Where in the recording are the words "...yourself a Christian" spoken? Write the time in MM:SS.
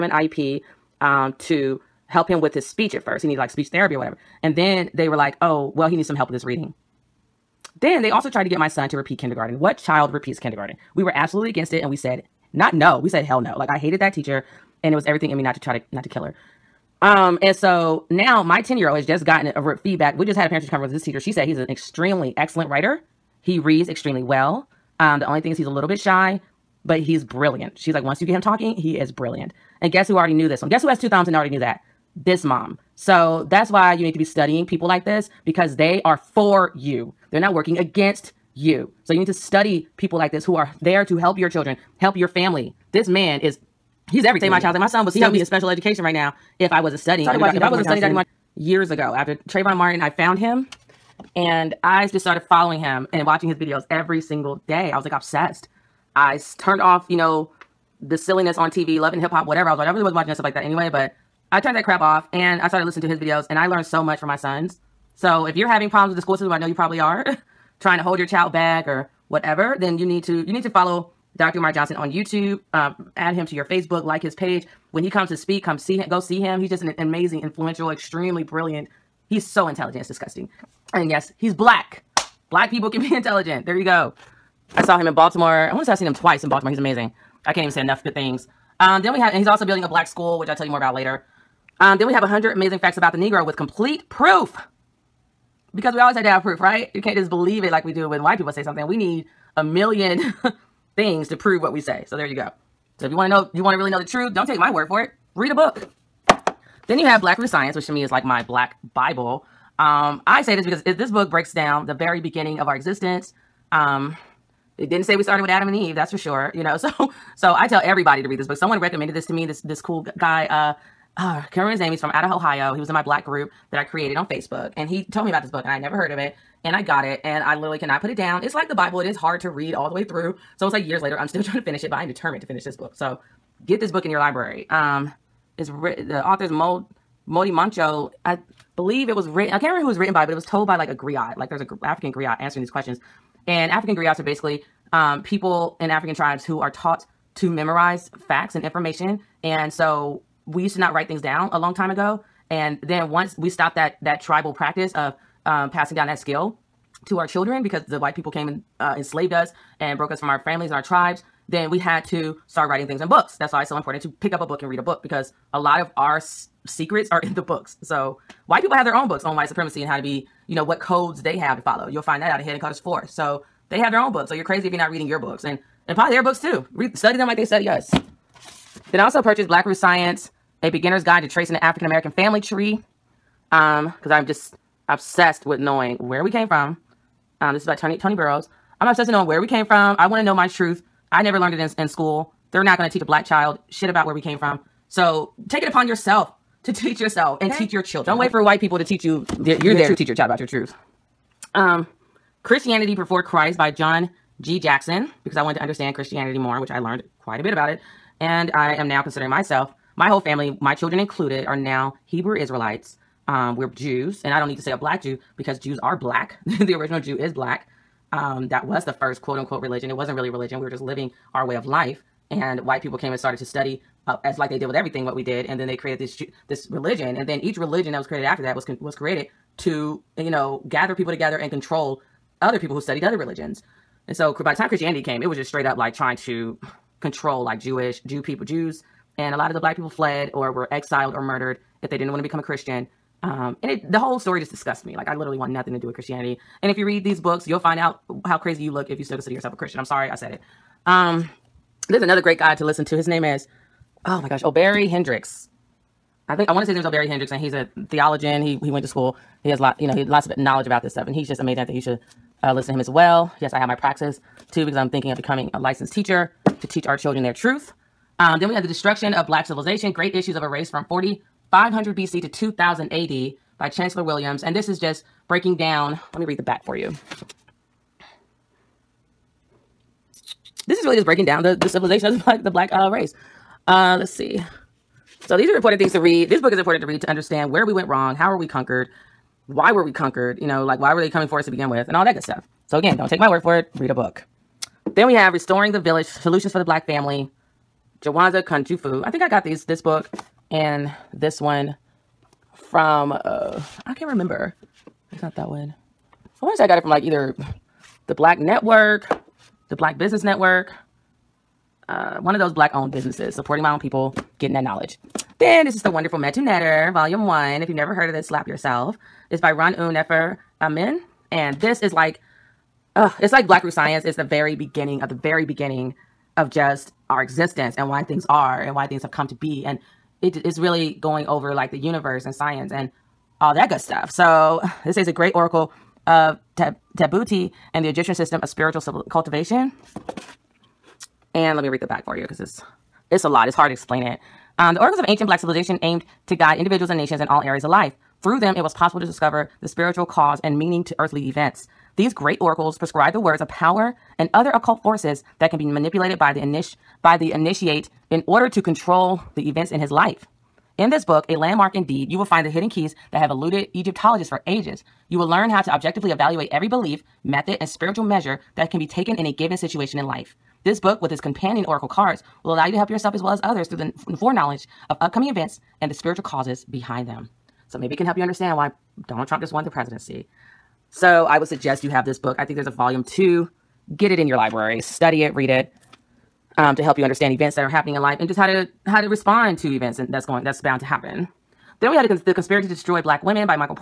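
04:09.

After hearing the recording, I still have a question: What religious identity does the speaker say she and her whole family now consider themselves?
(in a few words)
Hebrew Israelites.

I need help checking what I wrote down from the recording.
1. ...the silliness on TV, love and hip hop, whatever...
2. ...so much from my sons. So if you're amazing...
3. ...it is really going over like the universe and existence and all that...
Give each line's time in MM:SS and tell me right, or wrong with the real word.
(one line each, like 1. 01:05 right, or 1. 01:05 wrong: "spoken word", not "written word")
1. 00:58 right
2. 01:03 wrong: "having", not "amazing"
3. 05:30 wrong: "science", not "existence".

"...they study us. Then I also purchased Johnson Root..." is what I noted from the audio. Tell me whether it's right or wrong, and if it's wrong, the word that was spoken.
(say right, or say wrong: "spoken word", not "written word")
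wrong: "Black", not "Johnson".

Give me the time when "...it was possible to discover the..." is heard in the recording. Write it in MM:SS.
05:48.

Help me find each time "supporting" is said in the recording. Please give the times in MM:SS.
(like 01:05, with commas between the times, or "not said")
05:13.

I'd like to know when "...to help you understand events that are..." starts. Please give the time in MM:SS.
06:26.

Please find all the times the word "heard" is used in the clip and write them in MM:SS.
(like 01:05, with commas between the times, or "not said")
02:05, 05:17.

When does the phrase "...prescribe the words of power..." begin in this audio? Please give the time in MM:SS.
05:52.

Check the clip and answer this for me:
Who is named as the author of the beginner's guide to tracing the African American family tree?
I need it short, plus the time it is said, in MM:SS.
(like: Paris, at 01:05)
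Tony Burroughs, at 03:07.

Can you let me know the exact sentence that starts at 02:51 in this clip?
You'll find that out in Hidden Colors 4.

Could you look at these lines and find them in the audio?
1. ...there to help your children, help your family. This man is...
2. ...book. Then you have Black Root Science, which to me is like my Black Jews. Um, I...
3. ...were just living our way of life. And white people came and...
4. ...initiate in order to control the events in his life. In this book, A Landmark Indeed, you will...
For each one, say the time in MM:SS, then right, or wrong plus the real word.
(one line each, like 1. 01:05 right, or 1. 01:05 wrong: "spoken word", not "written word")
1. 00:40 right
2. 01:45 wrong: "Bible", not "Jews"
3. 03:40 right
4. 05:57 right.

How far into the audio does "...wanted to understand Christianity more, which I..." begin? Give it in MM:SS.
03:25.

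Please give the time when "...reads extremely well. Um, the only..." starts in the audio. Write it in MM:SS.
00:23.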